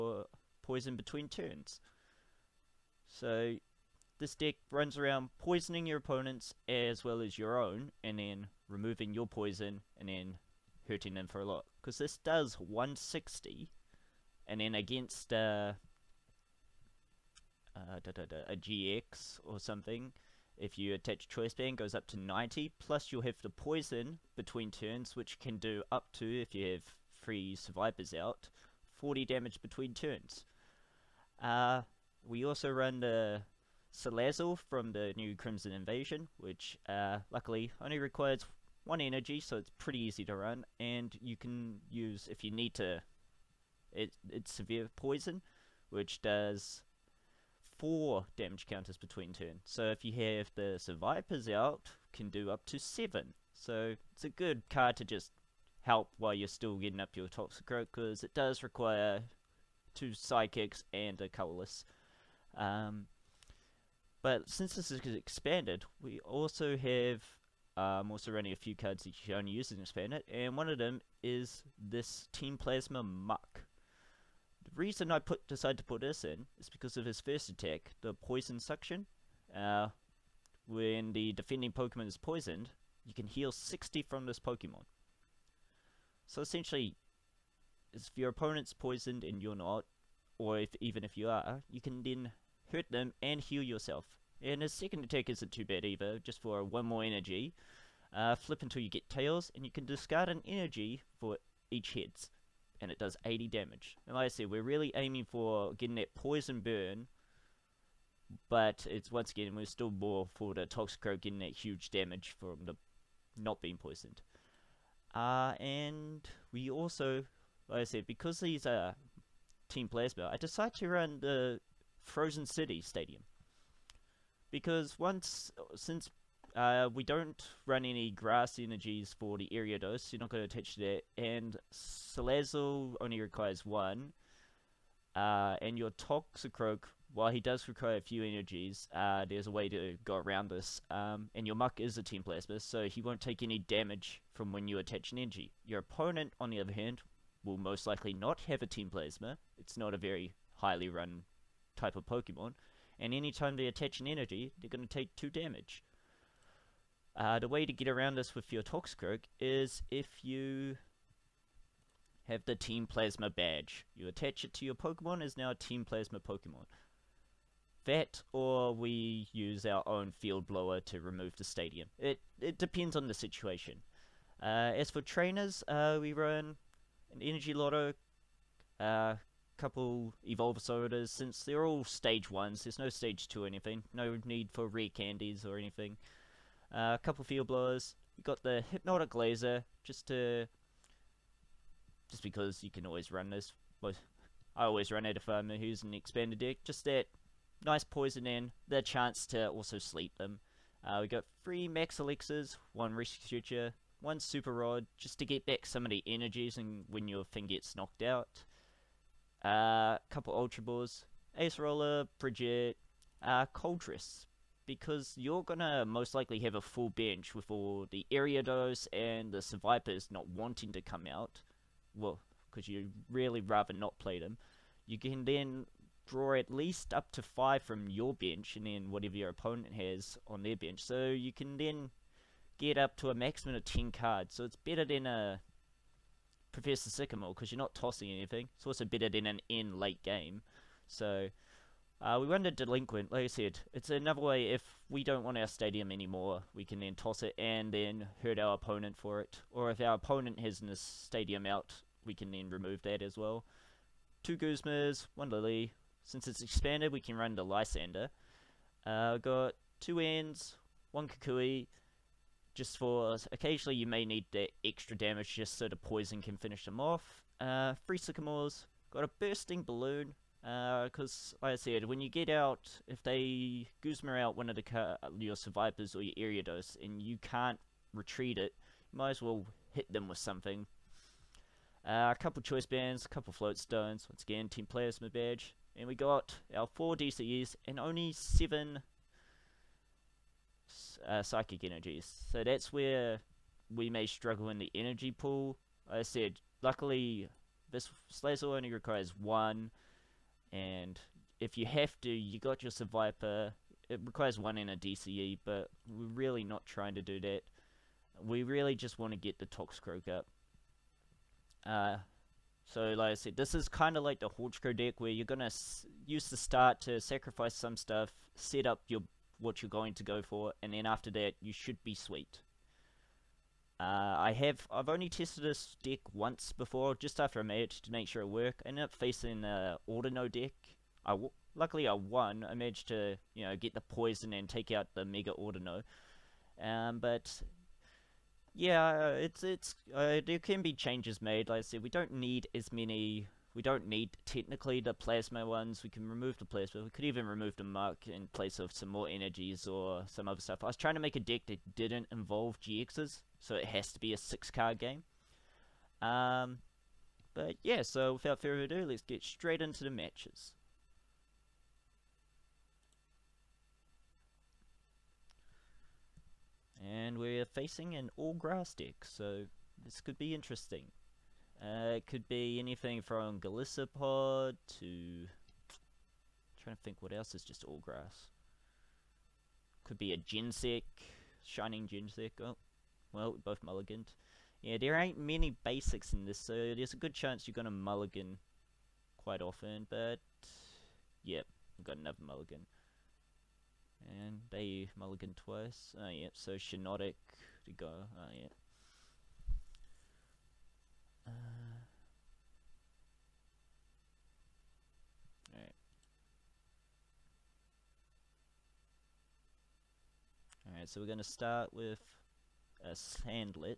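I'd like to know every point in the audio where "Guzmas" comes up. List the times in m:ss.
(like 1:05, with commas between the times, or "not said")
4:14, 4:33.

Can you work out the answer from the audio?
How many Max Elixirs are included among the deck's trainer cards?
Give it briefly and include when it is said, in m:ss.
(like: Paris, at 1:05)
3, at 3:21.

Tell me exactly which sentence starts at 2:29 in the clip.
It's not a very highly run type of Pokemon.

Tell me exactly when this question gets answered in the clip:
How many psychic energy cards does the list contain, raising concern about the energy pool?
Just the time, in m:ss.
4:48.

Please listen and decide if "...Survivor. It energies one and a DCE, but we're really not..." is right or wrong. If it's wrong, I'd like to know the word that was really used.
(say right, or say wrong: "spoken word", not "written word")
wrong: "requires", not "energies".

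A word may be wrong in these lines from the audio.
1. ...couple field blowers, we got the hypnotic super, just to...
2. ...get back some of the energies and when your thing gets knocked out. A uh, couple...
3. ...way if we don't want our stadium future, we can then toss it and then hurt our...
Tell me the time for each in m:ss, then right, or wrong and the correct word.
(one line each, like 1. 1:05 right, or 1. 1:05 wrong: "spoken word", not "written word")
1. 3:07 wrong: "laser", not "super"
2. 3:25 right
3. 4:04 wrong: "anymore", not "future".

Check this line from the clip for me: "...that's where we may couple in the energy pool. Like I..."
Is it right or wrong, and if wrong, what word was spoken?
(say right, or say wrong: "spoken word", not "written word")
wrong: "struggle", not "couple".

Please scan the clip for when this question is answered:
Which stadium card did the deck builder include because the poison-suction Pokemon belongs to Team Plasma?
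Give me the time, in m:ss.
2:02.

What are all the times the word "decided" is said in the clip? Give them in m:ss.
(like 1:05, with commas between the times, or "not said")
1:15, 2:00.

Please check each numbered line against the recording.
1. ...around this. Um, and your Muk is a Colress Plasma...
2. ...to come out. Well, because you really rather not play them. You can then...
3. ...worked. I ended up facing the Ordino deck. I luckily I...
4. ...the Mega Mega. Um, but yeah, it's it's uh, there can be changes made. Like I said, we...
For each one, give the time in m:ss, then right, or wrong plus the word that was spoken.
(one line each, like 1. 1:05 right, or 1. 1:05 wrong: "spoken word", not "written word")
1. 2:20 wrong: "Team", not "Colress"
2. 3:40 right
3. 5:28 right
4. 5:34 wrong: "Ordino", not "Mega".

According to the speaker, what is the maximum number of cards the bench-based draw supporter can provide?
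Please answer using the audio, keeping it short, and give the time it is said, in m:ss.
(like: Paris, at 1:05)
10, at 3:53.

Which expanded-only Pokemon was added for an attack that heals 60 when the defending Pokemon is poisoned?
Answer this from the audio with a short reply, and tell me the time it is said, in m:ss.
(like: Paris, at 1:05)
Team Plasma Muk, at 1:12.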